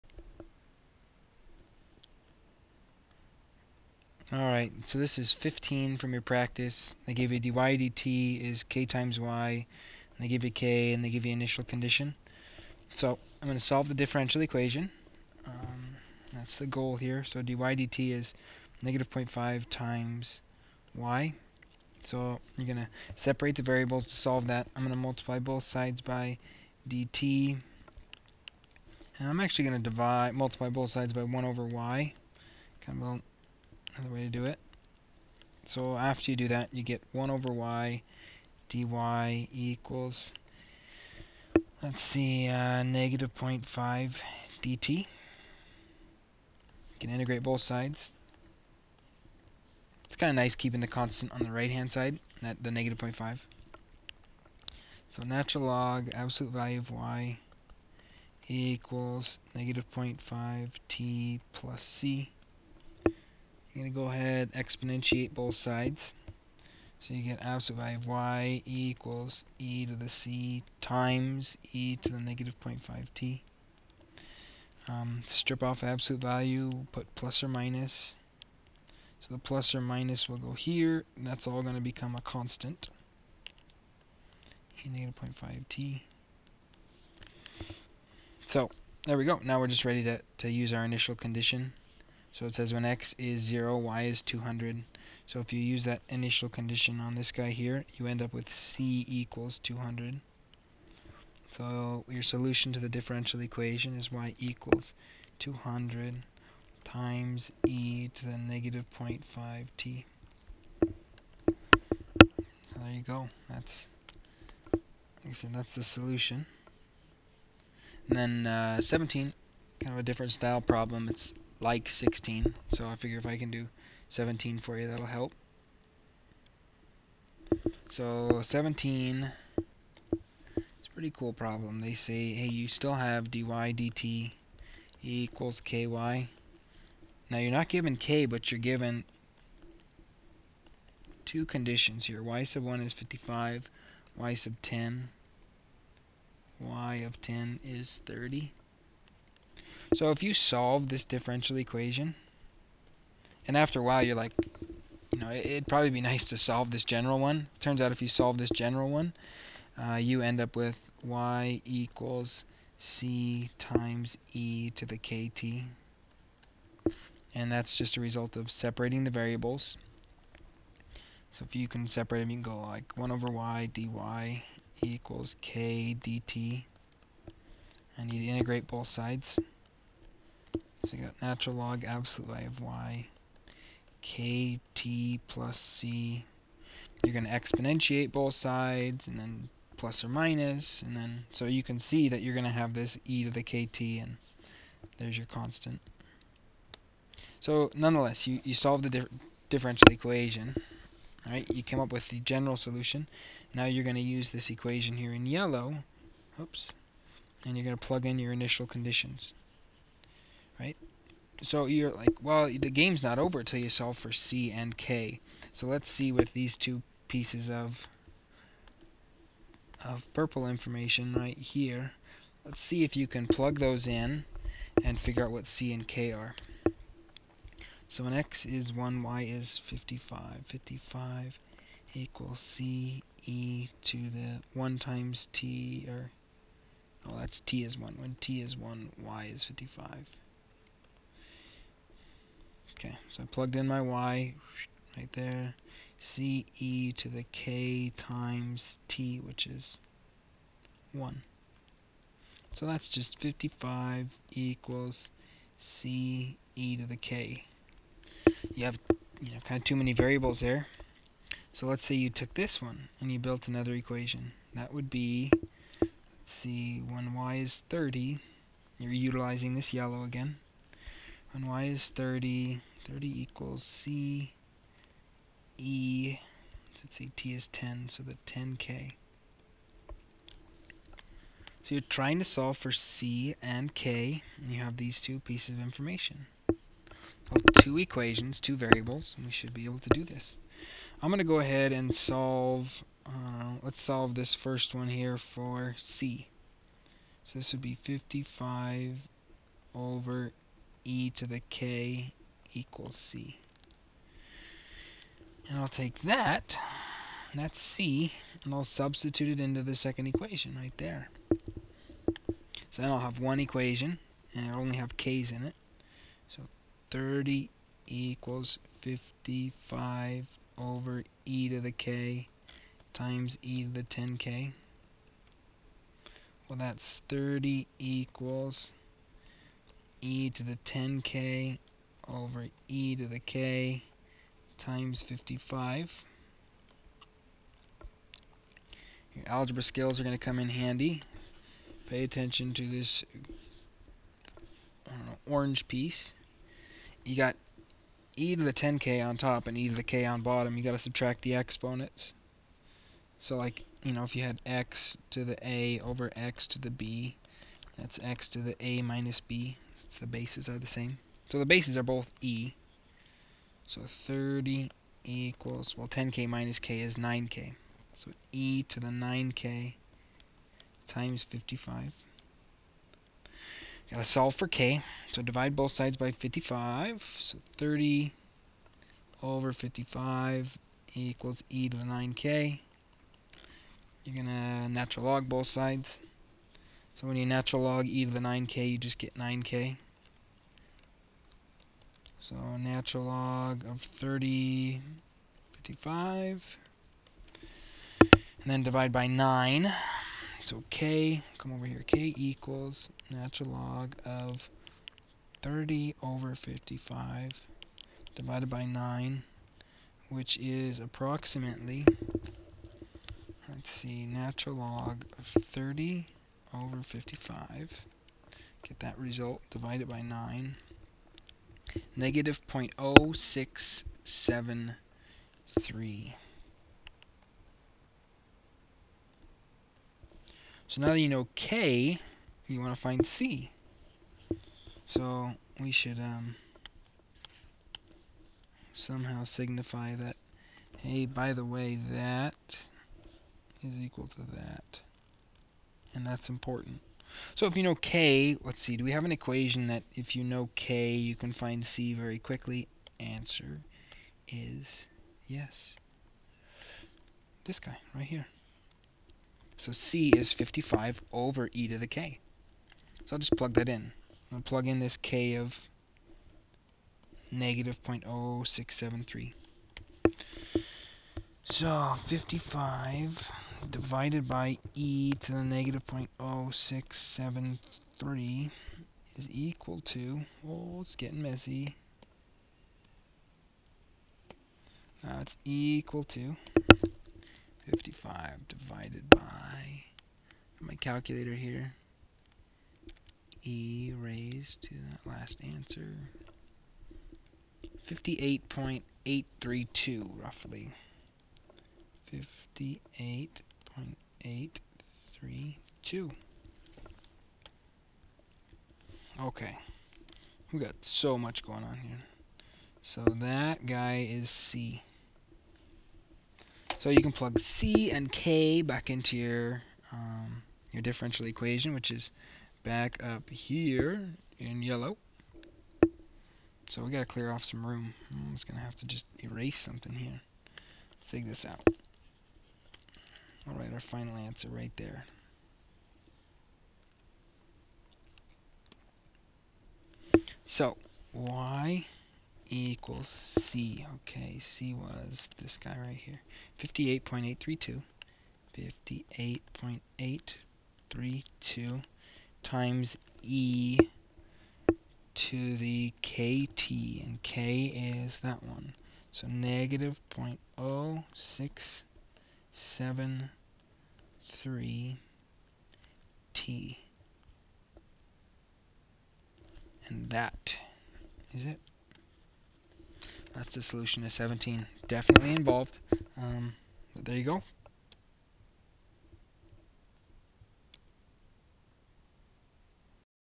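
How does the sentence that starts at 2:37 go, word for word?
Turns out if you solve this general one, uh, you end up with y equals c times e to the kt.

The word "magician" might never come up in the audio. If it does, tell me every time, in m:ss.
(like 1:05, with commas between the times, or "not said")
not said.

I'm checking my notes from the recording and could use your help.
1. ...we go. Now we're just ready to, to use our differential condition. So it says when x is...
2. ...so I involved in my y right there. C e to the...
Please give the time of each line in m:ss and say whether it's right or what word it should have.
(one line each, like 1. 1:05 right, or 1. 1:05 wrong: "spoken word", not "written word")
1. 1:29 wrong: "initial", not "differential"
2. 4:03 wrong: "plugged", not "involved".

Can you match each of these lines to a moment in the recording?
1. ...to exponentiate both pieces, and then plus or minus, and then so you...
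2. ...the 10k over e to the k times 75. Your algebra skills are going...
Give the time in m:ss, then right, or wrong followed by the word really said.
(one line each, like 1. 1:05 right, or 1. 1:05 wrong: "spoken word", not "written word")
1. 3:07 wrong: "sides", not "pieces"
2. 5:30 wrong: "55", not "75".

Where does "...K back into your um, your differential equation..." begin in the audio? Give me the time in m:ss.
8:38.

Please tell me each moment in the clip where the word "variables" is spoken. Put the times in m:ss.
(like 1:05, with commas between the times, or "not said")
0:23, 2:49, 4:19, 4:48.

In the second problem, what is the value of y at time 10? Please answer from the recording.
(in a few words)
30.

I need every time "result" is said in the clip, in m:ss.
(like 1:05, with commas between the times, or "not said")
2:48, 6:58.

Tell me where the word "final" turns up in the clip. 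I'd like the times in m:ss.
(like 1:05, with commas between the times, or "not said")
8:53.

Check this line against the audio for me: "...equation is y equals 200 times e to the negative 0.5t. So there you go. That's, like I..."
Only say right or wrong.
right.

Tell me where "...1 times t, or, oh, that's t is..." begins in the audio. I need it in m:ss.
3:54.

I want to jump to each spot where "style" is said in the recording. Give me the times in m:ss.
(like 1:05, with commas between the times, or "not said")
2:00.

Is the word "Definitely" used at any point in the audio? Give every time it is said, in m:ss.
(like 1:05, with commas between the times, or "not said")
9:34.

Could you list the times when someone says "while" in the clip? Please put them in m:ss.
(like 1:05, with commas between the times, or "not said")
2:33.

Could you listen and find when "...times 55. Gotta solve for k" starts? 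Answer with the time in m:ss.
6:10.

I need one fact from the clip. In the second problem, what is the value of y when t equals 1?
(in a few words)
55.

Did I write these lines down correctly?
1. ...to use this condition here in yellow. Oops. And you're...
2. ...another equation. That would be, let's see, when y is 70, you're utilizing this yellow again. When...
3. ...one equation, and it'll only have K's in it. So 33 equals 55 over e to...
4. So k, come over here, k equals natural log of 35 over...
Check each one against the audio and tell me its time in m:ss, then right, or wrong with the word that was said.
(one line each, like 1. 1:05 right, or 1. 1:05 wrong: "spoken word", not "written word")
1. 3:23 wrong: "equation", not "condition"
2. 4:23 wrong: "30", not "70"
3. 5:13 wrong: "30", not "33"
4. 6:40 wrong: "30", not "35".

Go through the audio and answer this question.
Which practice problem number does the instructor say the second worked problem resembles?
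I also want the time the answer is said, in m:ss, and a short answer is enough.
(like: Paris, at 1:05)
16, at 2:01.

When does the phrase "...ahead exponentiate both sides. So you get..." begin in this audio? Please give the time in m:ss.
1:04.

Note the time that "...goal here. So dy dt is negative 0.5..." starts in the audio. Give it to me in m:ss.
0:16.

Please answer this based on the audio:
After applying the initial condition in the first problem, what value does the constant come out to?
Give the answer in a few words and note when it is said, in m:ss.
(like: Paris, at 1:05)
200, at 1:38.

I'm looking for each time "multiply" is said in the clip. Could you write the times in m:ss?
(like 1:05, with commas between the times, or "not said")
0:24, 0:30.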